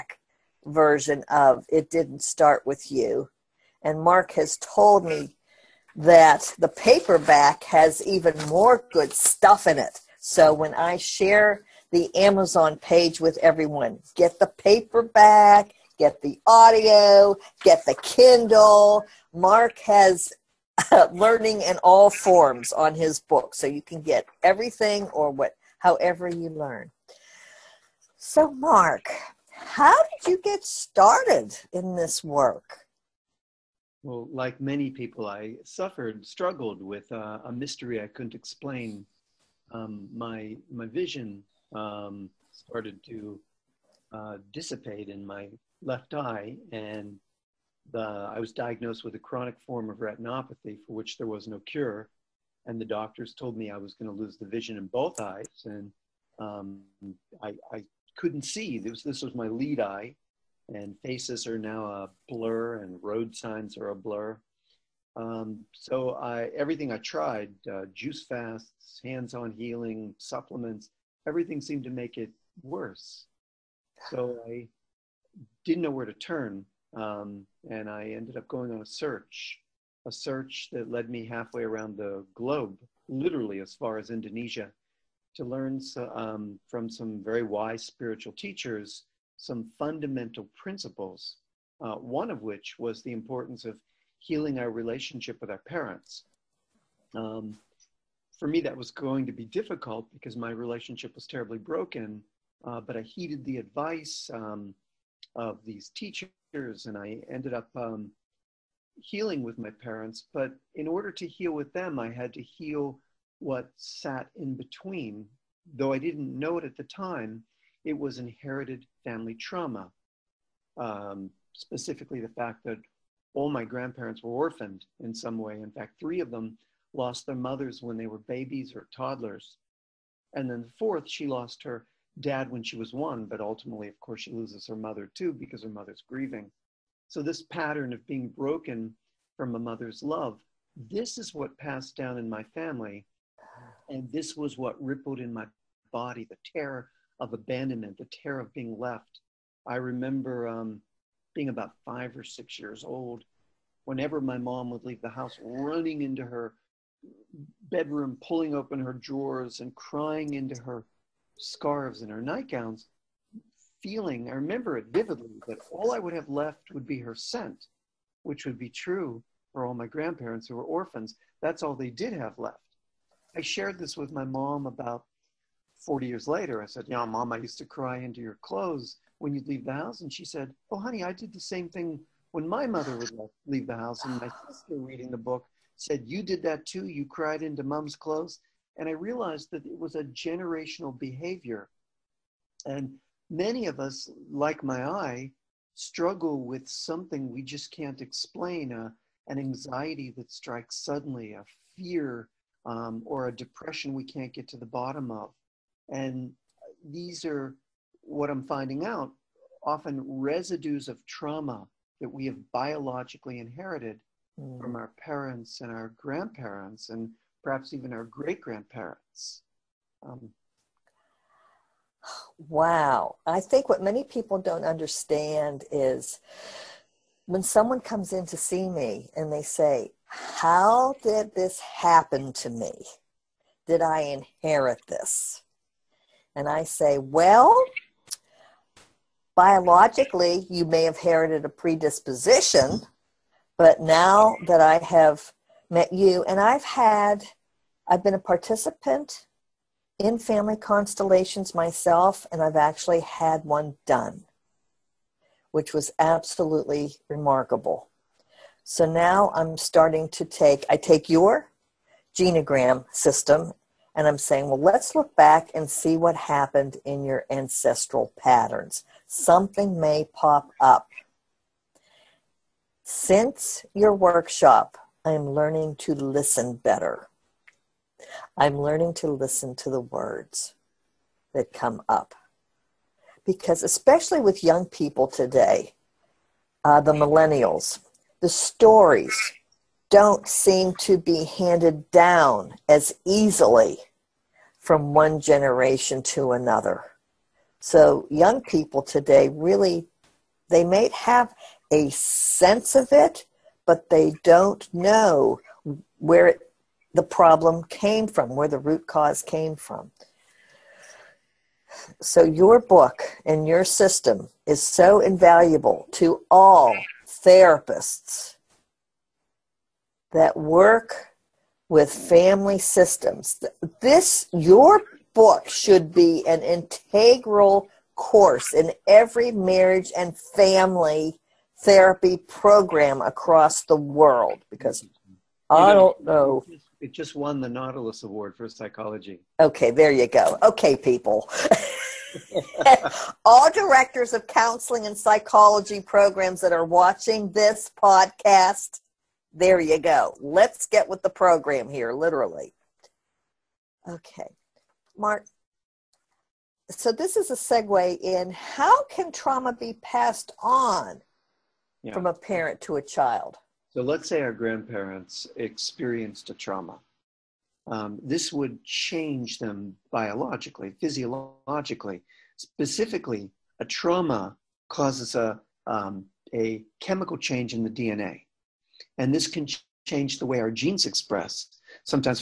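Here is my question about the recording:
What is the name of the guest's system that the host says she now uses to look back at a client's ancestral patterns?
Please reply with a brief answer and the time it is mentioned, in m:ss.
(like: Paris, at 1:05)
genogram, at 4:22.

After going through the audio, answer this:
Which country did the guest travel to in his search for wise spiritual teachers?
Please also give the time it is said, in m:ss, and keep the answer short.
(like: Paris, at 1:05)
Indonesia, at 1:24.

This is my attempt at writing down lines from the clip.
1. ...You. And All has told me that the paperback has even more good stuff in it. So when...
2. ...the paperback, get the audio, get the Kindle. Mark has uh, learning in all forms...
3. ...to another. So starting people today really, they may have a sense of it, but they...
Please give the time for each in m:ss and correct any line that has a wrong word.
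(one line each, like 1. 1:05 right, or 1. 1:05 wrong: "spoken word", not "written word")
1. 0:02 wrong: "Mark", not "All"
2. 0:14 right
3. 4:56 wrong: "young", not "starting".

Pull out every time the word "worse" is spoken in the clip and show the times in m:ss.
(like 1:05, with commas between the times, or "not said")
1:12.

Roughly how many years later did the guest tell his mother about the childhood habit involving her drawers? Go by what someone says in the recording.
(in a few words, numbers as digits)
40.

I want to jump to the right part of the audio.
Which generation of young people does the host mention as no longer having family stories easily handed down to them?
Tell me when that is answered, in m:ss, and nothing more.
4:46.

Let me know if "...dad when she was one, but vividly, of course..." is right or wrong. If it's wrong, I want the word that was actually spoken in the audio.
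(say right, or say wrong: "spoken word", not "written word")
wrong: "ultimately", not "vividly".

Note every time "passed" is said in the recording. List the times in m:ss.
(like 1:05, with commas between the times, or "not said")
2:21, 5:59.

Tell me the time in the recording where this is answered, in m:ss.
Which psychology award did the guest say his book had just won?
5:37.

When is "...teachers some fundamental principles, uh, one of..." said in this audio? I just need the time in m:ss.
1:28.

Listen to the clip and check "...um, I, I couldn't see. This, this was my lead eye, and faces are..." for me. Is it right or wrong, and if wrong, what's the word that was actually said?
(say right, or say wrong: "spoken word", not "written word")
right.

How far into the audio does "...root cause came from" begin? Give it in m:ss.
5:08.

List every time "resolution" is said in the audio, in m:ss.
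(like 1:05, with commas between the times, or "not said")
not said.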